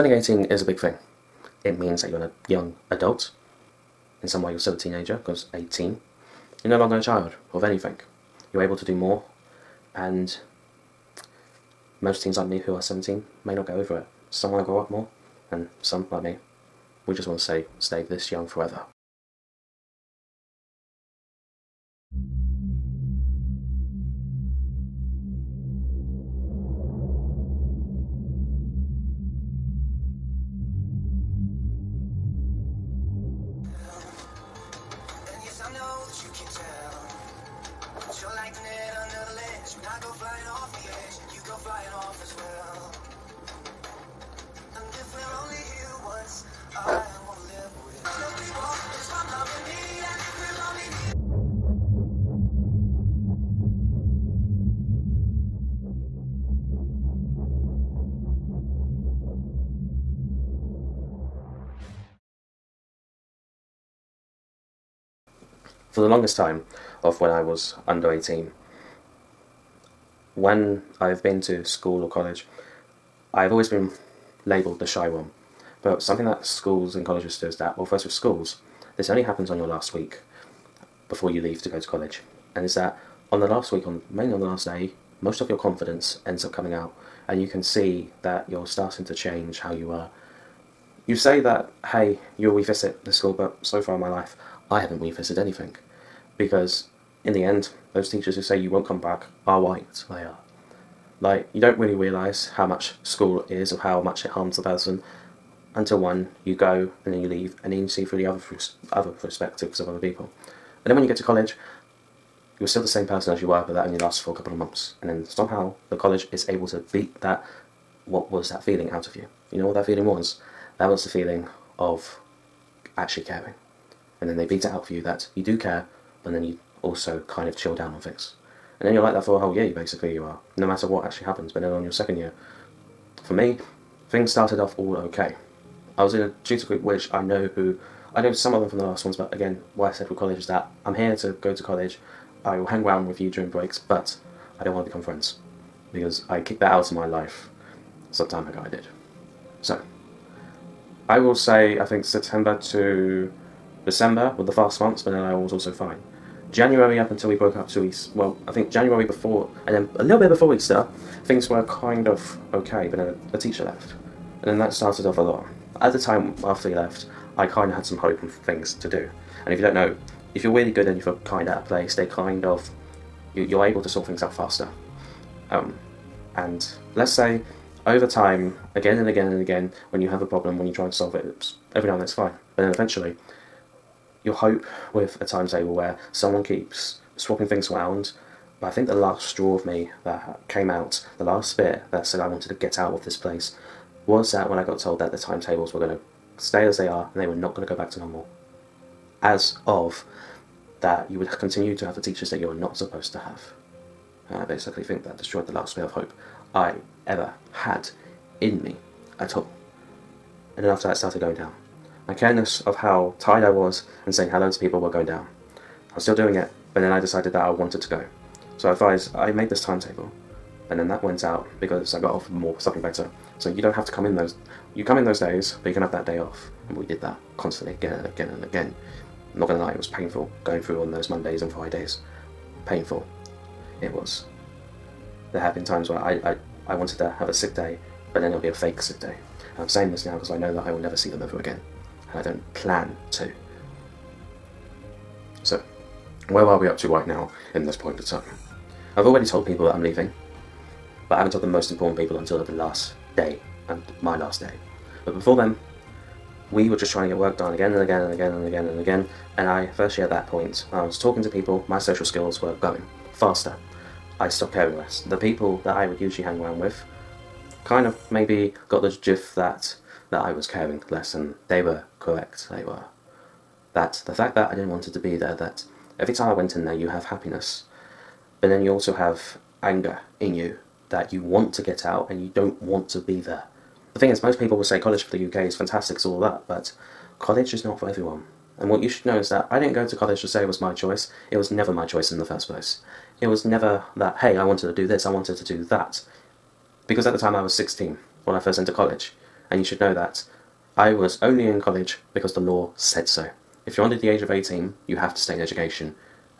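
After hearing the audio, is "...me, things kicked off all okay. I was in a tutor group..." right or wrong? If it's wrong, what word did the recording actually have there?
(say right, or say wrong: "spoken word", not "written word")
wrong: "started", not "kicked".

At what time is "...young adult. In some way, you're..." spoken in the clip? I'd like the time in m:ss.
0:02.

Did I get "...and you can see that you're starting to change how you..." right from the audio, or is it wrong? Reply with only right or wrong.
right.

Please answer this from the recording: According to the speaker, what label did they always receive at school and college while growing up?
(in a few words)
the shy one.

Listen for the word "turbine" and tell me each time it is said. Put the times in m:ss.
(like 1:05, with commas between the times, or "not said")
not said.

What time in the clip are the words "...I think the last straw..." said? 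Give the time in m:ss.
3:08.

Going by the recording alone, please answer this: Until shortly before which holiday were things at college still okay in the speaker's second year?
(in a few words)
Easter.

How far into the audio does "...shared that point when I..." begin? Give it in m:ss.
4:19.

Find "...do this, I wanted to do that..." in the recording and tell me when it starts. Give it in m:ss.
4:54.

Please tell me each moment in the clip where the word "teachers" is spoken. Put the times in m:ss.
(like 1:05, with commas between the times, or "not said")
1:38, 2:43, 3:22.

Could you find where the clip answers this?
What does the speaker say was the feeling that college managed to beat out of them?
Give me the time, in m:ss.
2:02.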